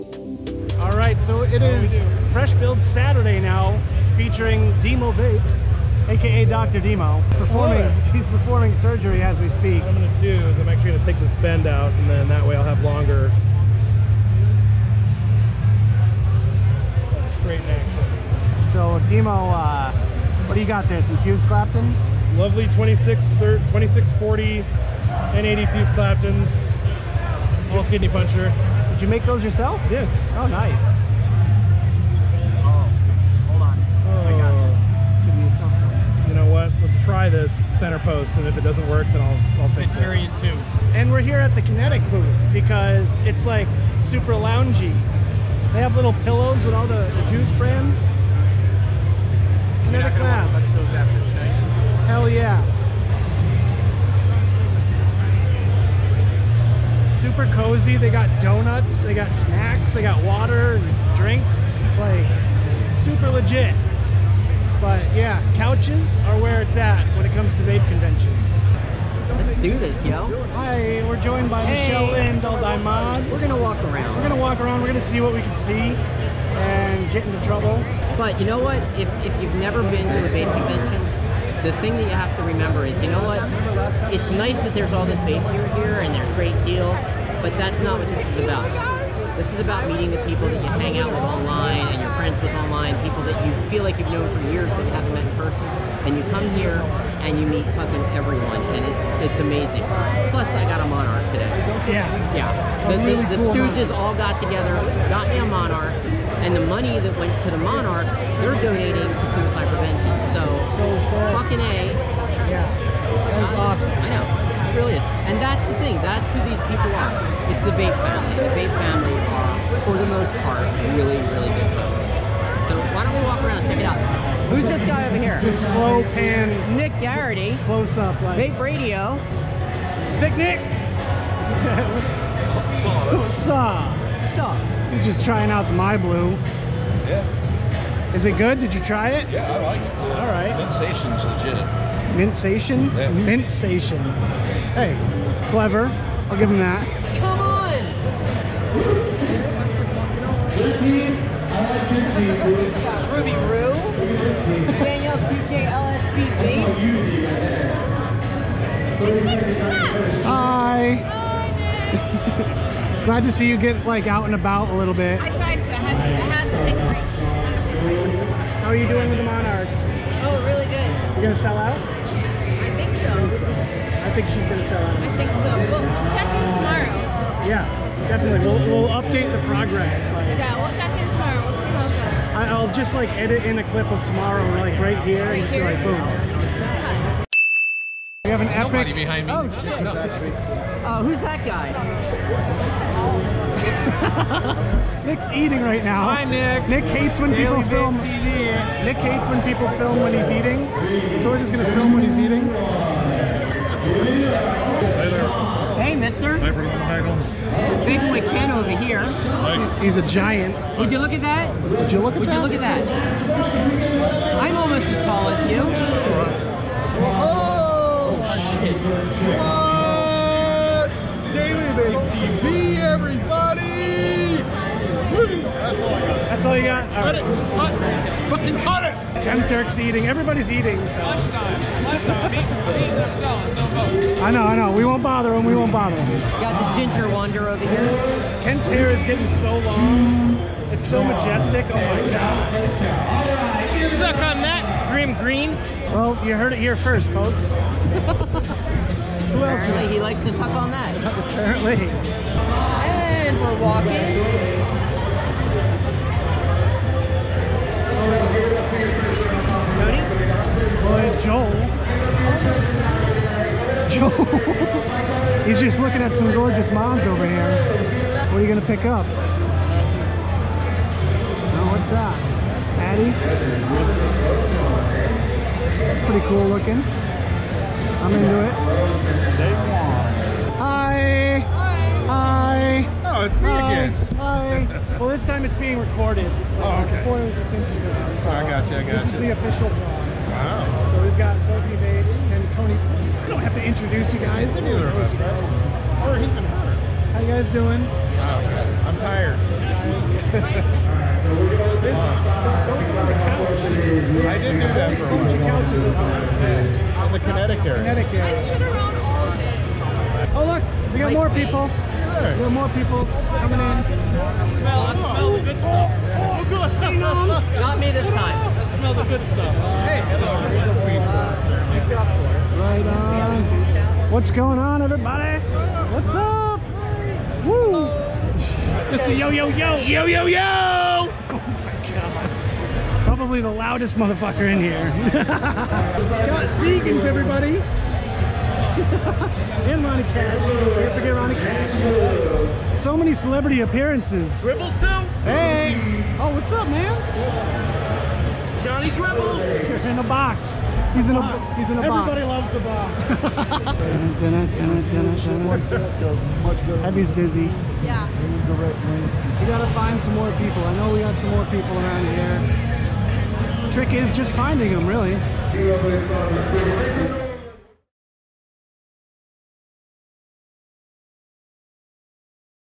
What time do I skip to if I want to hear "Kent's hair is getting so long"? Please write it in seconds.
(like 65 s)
238 s.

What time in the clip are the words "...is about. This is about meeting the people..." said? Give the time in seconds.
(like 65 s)
88 s.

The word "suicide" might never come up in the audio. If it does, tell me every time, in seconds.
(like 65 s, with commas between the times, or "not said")
109 s.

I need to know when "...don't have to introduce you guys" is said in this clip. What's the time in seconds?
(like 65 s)
293 s.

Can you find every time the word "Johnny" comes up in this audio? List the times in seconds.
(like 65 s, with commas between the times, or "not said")
348 s.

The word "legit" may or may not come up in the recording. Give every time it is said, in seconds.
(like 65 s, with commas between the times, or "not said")
63 s, 141 s.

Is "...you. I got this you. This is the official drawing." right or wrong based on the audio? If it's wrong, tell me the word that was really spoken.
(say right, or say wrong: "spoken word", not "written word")
right.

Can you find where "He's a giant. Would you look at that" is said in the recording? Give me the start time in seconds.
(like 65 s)
209 s.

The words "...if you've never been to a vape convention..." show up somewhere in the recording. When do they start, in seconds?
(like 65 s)
79 s.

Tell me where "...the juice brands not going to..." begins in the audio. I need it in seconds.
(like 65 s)
47 s.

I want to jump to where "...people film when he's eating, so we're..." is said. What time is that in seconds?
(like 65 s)
199 s.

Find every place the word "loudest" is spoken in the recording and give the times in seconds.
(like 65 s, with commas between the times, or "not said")
333 s.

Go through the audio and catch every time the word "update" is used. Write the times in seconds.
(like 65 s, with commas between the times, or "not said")
178 s.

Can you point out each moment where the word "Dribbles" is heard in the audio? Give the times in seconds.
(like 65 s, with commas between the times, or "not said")
344 s, 348 s.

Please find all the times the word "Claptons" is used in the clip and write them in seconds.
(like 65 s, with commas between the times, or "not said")
21 s, 25 s.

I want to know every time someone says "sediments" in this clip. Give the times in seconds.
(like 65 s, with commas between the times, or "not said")
not said.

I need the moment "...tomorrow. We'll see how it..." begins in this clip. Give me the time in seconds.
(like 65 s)
181 s.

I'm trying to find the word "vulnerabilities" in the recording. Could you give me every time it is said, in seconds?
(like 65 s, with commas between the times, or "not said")
not said.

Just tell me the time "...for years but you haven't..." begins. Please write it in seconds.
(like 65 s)
94 s.